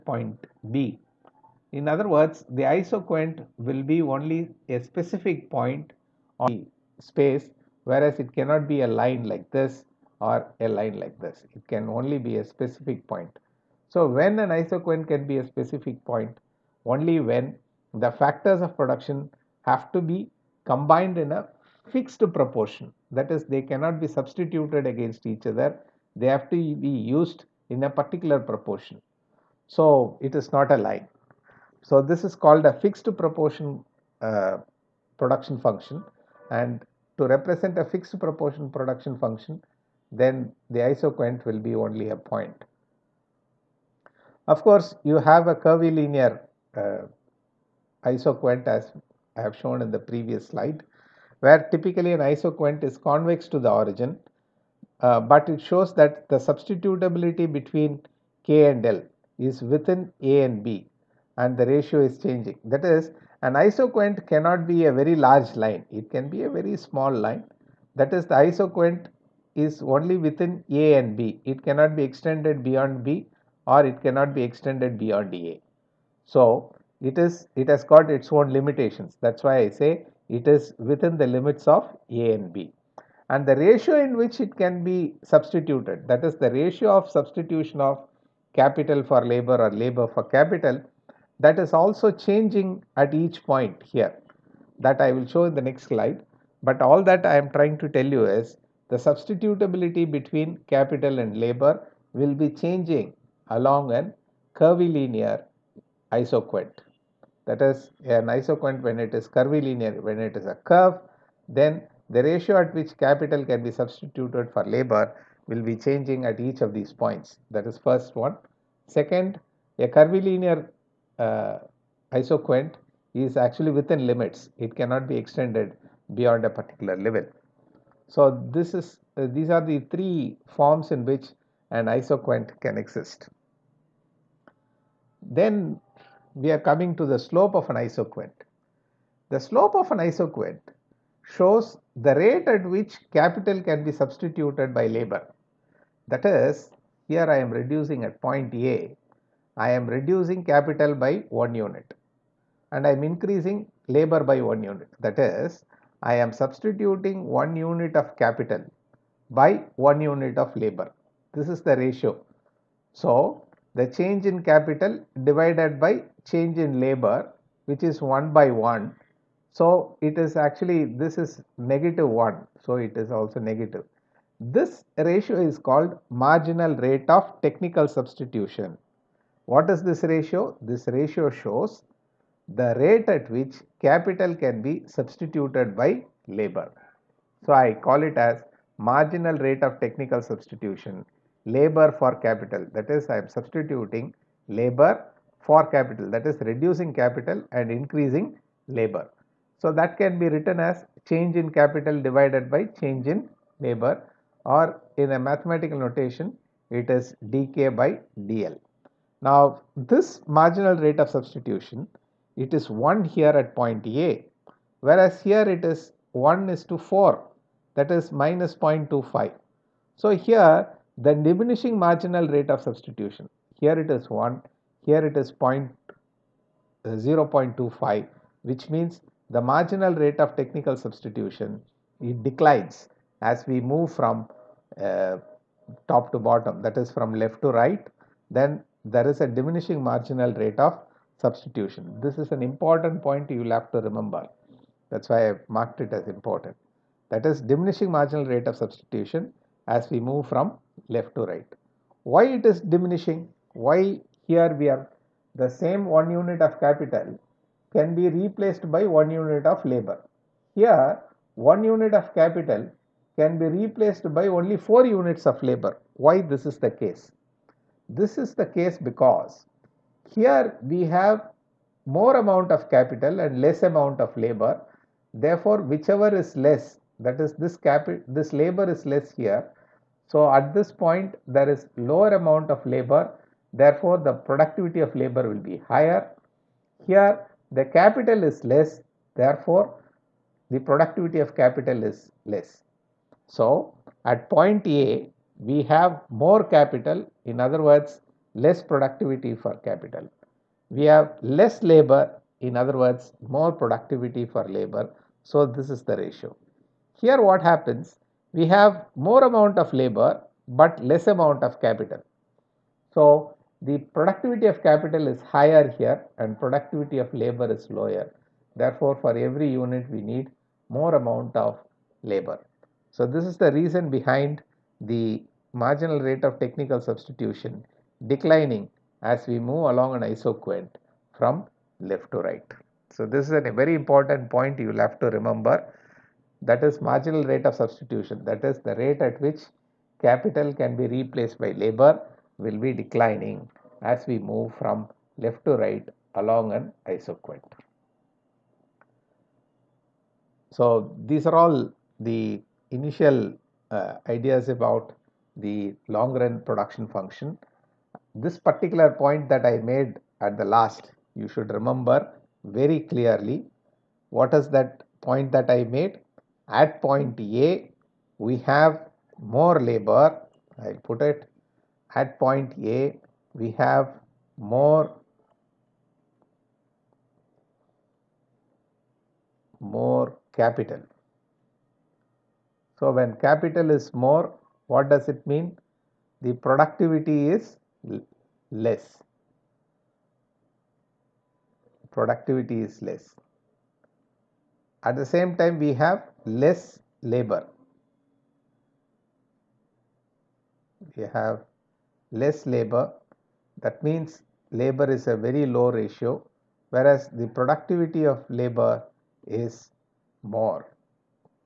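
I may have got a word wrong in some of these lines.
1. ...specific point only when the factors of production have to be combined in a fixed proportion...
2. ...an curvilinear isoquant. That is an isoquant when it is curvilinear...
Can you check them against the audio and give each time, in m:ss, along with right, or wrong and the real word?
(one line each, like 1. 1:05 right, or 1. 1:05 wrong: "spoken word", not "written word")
1. 0:15 right
2. 1:43 right.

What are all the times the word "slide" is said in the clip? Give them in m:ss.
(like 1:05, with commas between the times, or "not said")
0:50, 1:35.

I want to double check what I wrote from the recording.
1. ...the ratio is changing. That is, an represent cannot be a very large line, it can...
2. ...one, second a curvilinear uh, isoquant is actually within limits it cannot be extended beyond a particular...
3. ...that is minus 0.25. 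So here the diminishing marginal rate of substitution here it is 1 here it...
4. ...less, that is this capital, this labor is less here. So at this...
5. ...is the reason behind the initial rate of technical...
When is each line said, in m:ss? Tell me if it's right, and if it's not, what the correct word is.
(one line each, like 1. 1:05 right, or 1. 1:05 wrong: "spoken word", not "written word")
1. 1:01 wrong: "isoquant", not "represent"
2. 1:58 right
3. 3:37 right
4. 4:36 right
5. 5:23 wrong: "marginal", not "initial".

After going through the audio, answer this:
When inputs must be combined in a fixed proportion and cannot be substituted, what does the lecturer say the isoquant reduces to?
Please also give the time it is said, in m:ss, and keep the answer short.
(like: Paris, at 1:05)
a point, at 0:40.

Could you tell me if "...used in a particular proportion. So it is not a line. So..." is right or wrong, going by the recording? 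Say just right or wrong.
right.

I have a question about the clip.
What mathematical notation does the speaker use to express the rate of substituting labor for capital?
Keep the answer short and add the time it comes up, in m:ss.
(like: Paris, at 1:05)
dk by dl, at 3:27.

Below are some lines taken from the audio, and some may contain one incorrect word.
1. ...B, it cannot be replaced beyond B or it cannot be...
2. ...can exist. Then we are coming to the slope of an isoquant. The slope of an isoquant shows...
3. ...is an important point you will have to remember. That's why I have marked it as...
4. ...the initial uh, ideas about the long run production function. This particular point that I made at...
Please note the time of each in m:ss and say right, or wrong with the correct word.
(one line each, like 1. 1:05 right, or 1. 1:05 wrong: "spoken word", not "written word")
1. 1:11 wrong: "extended", not "replaced"
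2. 2:12 right
3. 4:02 right
4. 5:51 right.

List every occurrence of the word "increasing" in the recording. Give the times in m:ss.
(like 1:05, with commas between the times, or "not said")
2:33, 3:17.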